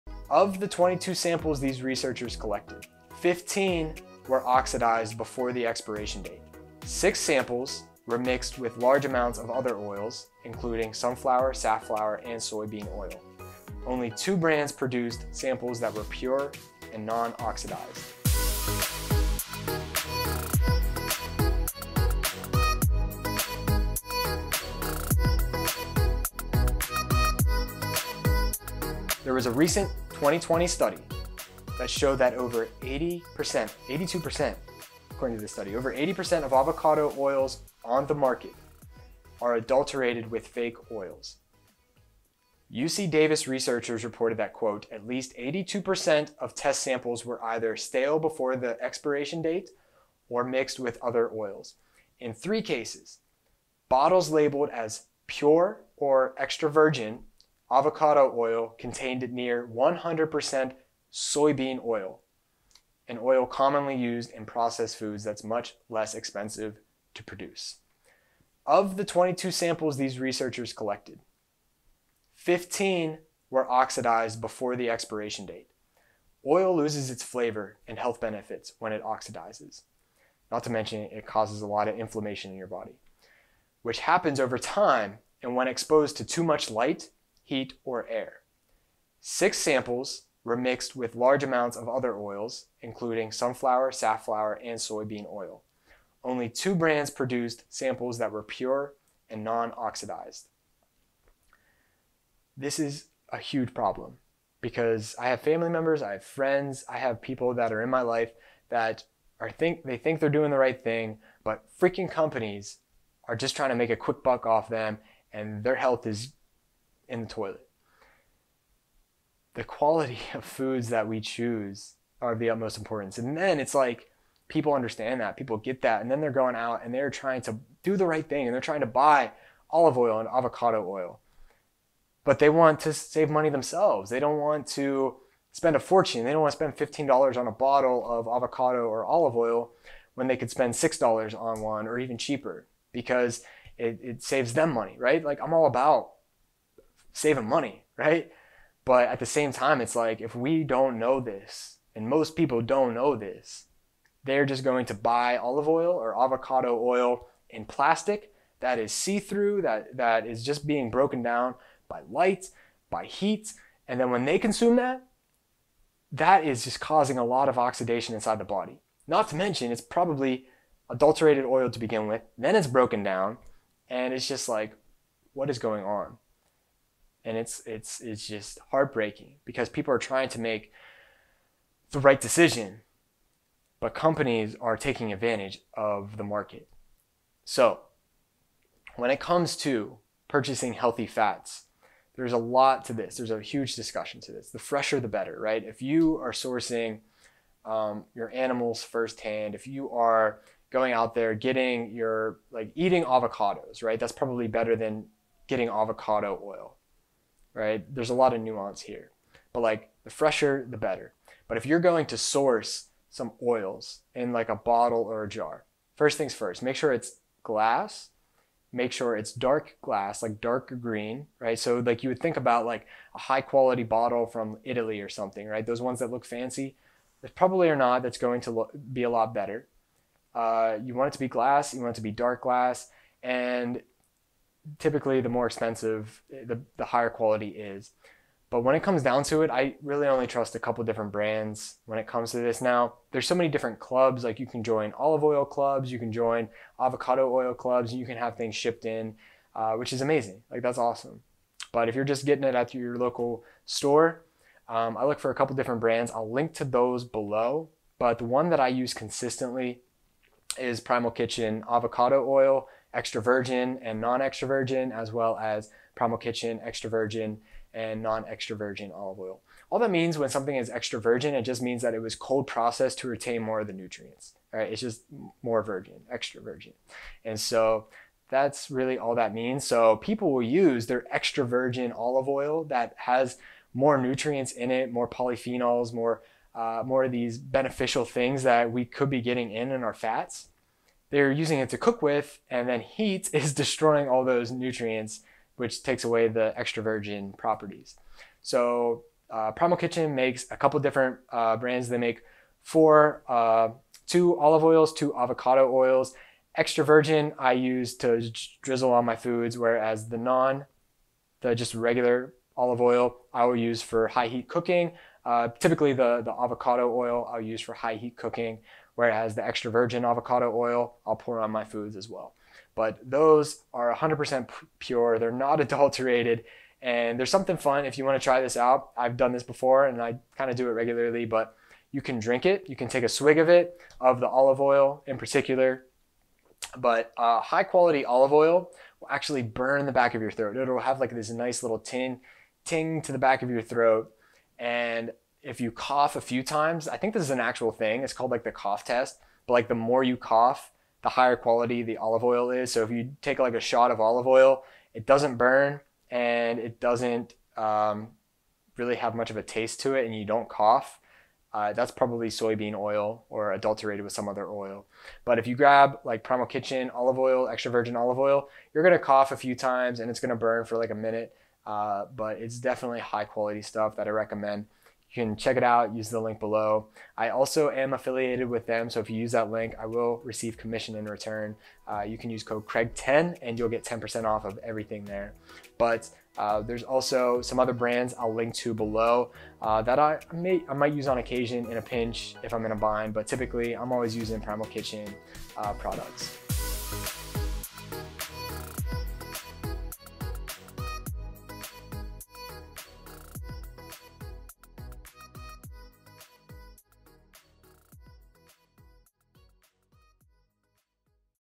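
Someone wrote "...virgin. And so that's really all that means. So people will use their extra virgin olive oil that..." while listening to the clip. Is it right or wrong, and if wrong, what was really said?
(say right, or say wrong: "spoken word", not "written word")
right.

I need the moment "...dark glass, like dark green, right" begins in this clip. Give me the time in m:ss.
3:39.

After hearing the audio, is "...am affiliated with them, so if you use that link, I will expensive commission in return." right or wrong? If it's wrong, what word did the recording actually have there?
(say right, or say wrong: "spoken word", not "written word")
wrong: "receive", not "expensive".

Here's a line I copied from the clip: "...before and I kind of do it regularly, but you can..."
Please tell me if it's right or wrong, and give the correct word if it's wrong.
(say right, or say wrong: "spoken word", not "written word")
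right.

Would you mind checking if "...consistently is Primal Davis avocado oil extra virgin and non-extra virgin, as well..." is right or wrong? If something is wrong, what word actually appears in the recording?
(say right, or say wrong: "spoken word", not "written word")
wrong: "Kitchen", not "Davis".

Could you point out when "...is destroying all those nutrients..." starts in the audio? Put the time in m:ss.
4:53.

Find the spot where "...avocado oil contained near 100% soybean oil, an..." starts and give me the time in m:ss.
0:57.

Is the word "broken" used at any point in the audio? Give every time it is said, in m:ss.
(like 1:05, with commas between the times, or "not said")
2:40, 2:52.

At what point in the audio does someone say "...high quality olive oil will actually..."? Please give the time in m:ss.
5:37.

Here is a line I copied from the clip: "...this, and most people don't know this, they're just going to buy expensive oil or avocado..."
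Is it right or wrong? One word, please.
wrong.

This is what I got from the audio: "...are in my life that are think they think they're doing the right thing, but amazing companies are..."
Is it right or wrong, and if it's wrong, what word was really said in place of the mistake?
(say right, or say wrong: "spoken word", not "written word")
wrong: "freaking", not "amazing".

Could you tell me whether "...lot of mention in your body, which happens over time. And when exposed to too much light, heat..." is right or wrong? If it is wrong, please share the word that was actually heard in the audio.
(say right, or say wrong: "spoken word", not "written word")
wrong: "inflammation", not "mention".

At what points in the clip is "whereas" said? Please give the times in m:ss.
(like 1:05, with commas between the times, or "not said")
5:09, 5:18.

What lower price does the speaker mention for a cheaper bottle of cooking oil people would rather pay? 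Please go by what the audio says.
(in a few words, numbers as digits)
$6.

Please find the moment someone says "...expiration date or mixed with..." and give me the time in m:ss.
0:48.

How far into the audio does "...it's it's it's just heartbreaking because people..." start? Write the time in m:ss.
2:57.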